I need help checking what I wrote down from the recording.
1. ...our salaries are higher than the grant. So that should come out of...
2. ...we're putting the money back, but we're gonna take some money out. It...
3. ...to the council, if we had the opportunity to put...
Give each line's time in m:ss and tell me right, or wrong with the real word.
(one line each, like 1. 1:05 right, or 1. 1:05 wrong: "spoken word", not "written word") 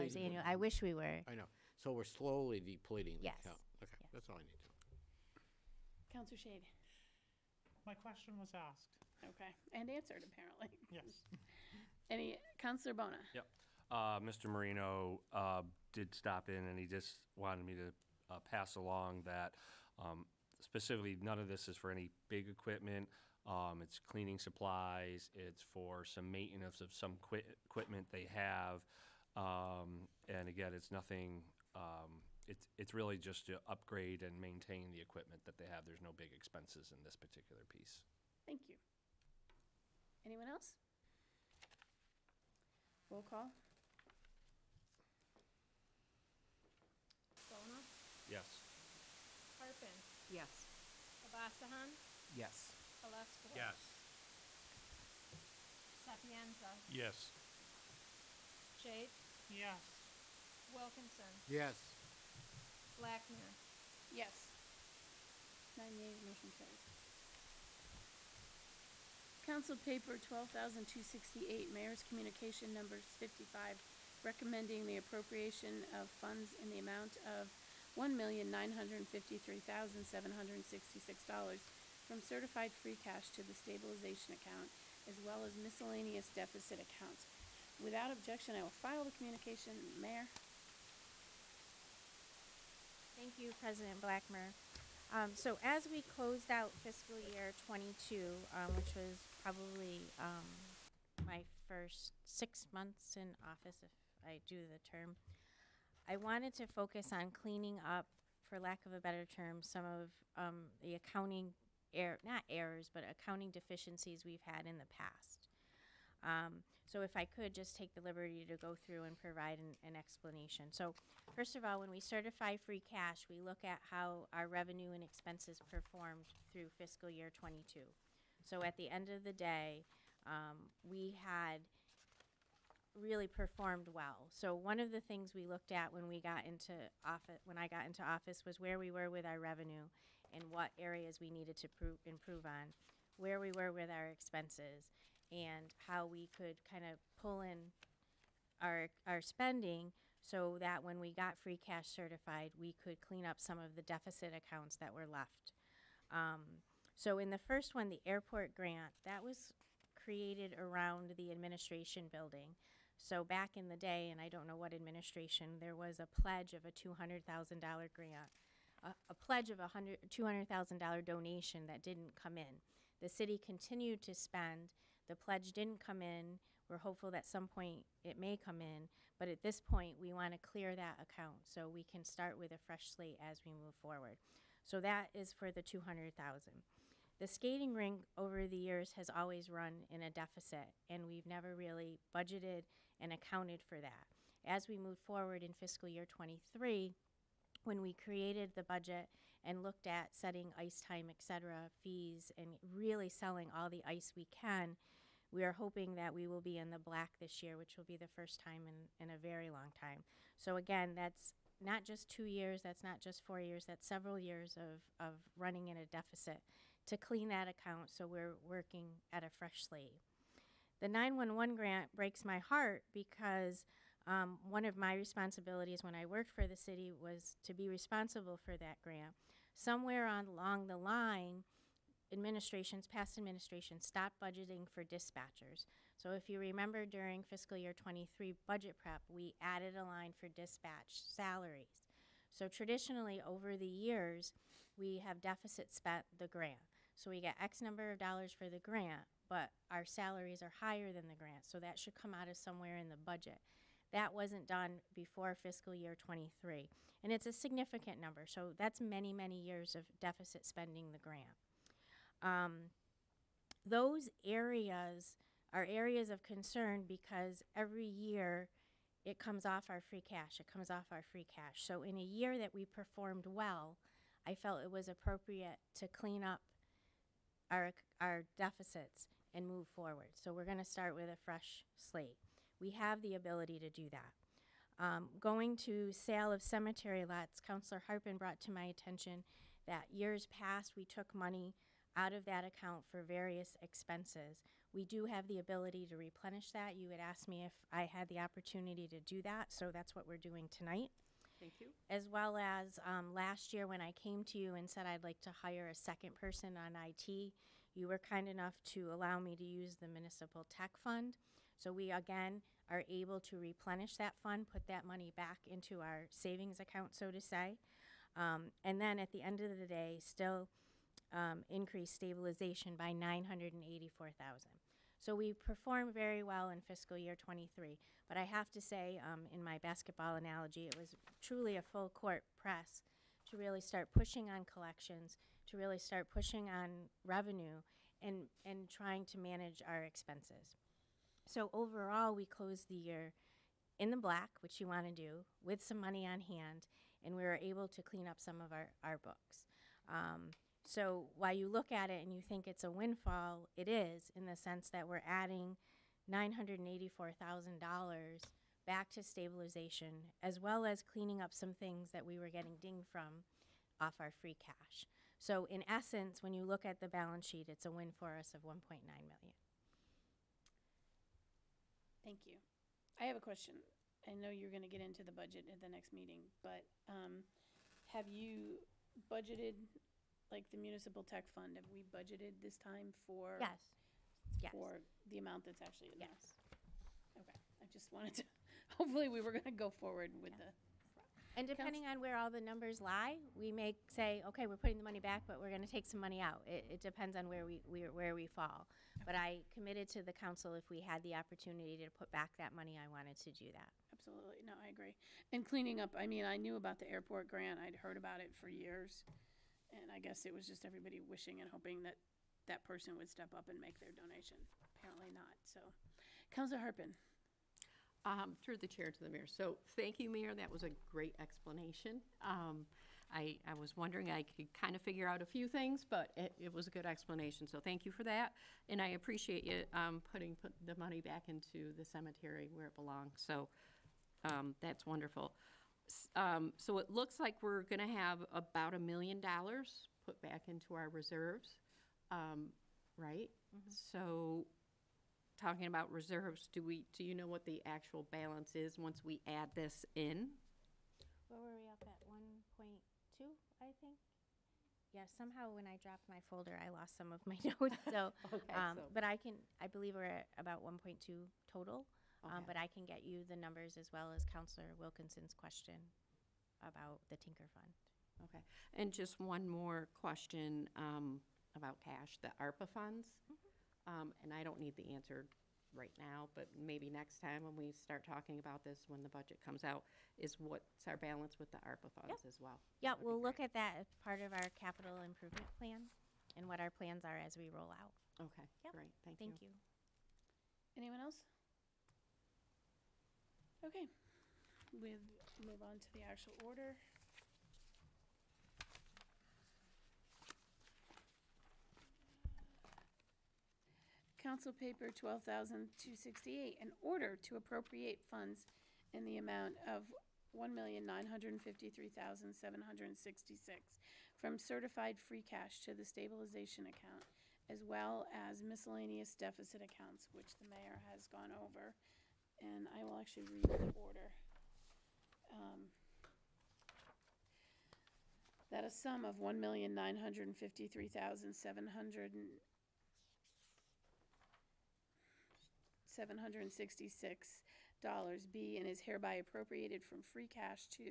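1. 4:09 right
2. 6:34 right
3. 6:39 right.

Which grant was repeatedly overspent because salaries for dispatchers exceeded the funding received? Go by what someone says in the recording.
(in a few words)
911 grant.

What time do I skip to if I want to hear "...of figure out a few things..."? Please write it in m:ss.
7:04.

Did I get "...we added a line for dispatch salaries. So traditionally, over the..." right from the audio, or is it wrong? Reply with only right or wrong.
right.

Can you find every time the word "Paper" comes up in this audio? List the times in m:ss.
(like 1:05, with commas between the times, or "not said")
1:09, 8:24.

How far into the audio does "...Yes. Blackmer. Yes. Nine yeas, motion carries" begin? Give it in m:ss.
1:01.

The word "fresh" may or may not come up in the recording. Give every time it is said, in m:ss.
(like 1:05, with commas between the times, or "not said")
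3:02, 3:39, 4:41.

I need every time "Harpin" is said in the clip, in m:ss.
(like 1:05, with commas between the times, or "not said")
0:49, 4:47, 6:56.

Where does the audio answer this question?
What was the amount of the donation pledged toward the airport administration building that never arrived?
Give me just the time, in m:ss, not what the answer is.
2:50.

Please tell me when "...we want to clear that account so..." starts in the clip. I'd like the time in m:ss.
3:00.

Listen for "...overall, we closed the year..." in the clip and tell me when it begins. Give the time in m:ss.
5:41.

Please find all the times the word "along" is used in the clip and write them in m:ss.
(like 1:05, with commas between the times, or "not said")
0:18, 3:50.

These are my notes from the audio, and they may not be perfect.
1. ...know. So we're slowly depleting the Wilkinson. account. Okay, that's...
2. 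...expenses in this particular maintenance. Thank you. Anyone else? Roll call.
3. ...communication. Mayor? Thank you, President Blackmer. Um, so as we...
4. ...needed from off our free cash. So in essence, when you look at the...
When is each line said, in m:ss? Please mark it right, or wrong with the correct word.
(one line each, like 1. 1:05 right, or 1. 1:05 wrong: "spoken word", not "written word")
1. 0:01 wrong: "Yes", not "Wilkinson"
2. 0:36 wrong: "piece", not "maintenance"
3. 1:29 right
4. 6:02 wrong: "dinged", not "needed".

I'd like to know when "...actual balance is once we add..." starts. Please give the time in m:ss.
7:27.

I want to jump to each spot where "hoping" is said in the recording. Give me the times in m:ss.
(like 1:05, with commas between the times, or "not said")
3:25, 6:51.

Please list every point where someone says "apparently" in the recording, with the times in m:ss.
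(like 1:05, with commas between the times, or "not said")
0:10, 6:54.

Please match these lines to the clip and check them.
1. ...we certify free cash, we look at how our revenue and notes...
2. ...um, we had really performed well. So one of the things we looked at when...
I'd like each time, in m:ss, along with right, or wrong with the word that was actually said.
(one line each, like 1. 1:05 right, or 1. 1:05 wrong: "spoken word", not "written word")
1. 2:01 wrong: "expenses", not "notes"
2. 2:10 right.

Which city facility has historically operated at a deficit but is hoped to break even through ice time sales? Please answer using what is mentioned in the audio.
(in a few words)
skating rink.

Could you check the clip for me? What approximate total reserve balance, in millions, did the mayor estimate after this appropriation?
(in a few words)
1.2.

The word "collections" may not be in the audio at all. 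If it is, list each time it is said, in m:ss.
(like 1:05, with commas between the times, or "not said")
5:34.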